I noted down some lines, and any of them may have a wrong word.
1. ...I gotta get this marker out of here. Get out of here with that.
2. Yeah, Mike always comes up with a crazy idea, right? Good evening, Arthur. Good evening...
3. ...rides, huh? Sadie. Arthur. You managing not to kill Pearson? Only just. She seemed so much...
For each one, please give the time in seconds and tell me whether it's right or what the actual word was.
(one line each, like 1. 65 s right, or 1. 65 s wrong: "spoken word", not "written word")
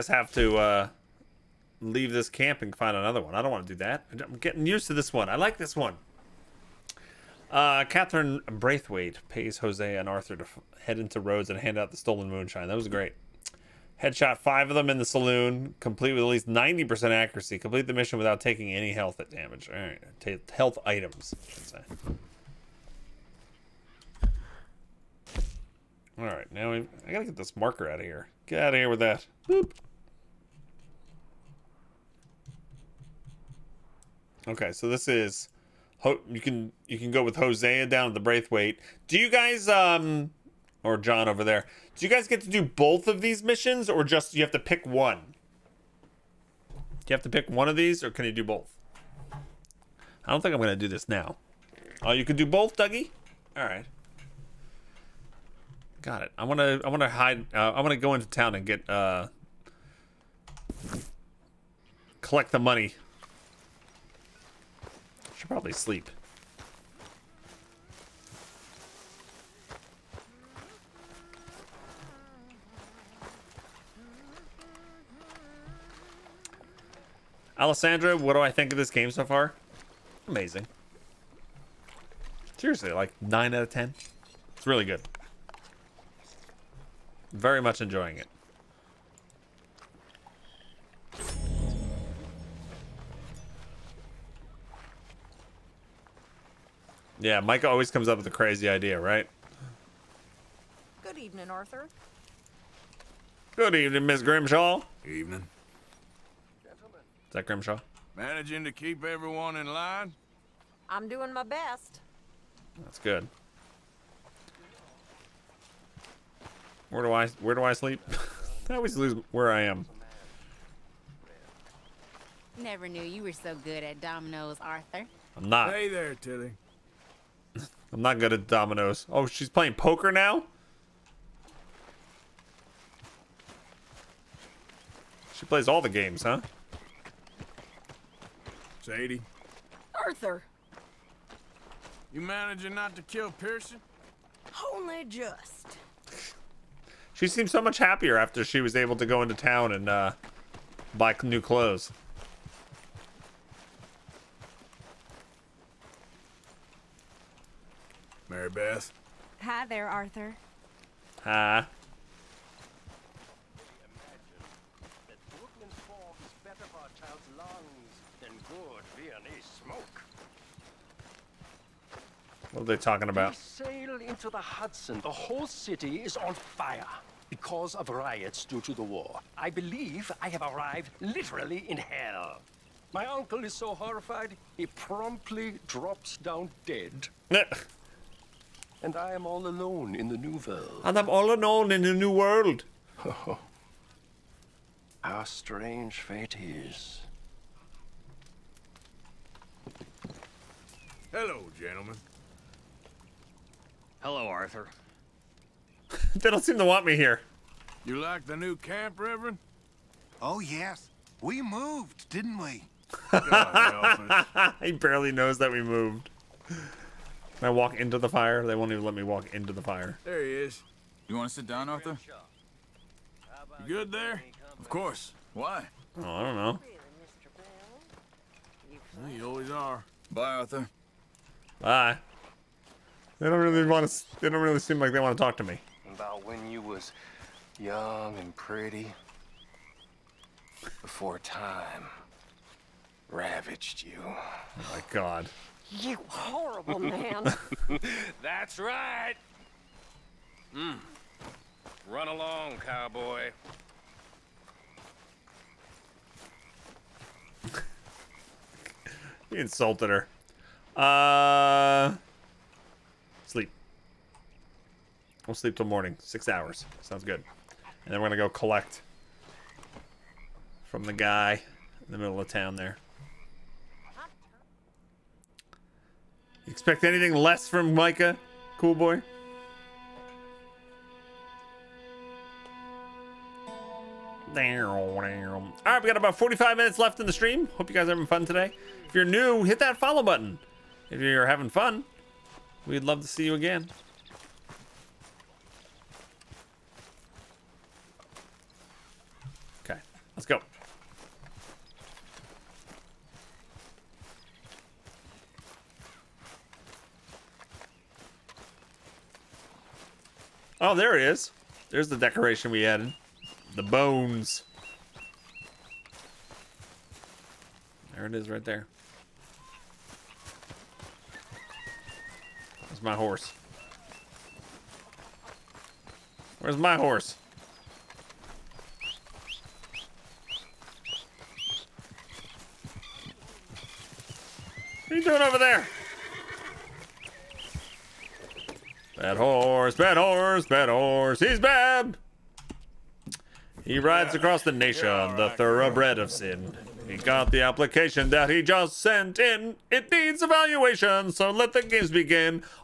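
1. 27 s right
2. 97 s right
3. 135 s wrong: "games", not "rides".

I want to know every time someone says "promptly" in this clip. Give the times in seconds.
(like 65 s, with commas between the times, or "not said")
184 s.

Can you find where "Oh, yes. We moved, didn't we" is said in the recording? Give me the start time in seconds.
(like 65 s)
210 s.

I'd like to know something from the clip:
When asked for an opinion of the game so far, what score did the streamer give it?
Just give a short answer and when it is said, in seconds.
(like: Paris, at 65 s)
9 out of 10, at 83 s.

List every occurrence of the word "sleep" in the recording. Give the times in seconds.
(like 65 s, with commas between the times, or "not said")
65 s, 117 s, 265 s.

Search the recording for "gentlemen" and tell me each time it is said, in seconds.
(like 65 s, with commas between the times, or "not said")
106 s, 201 s.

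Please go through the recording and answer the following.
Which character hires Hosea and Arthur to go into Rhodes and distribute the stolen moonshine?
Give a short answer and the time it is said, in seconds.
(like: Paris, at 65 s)
Catherine Braithwaite, at 7 s.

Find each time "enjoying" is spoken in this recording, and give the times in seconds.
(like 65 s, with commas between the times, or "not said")
87 s.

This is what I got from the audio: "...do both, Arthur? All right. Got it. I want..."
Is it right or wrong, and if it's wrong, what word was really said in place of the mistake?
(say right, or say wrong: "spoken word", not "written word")
wrong: "Dougie", not "Arthur".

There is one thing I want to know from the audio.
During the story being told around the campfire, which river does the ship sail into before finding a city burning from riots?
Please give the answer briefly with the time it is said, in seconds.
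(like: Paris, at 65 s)
Hudson, at 174 s.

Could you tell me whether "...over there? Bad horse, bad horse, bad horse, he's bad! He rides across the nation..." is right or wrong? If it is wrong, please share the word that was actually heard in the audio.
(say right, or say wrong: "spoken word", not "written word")
right.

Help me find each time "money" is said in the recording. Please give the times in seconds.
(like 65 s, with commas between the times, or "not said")
62 s.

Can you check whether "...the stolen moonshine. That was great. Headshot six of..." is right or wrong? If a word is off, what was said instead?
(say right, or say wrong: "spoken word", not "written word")
wrong: "five", not "six".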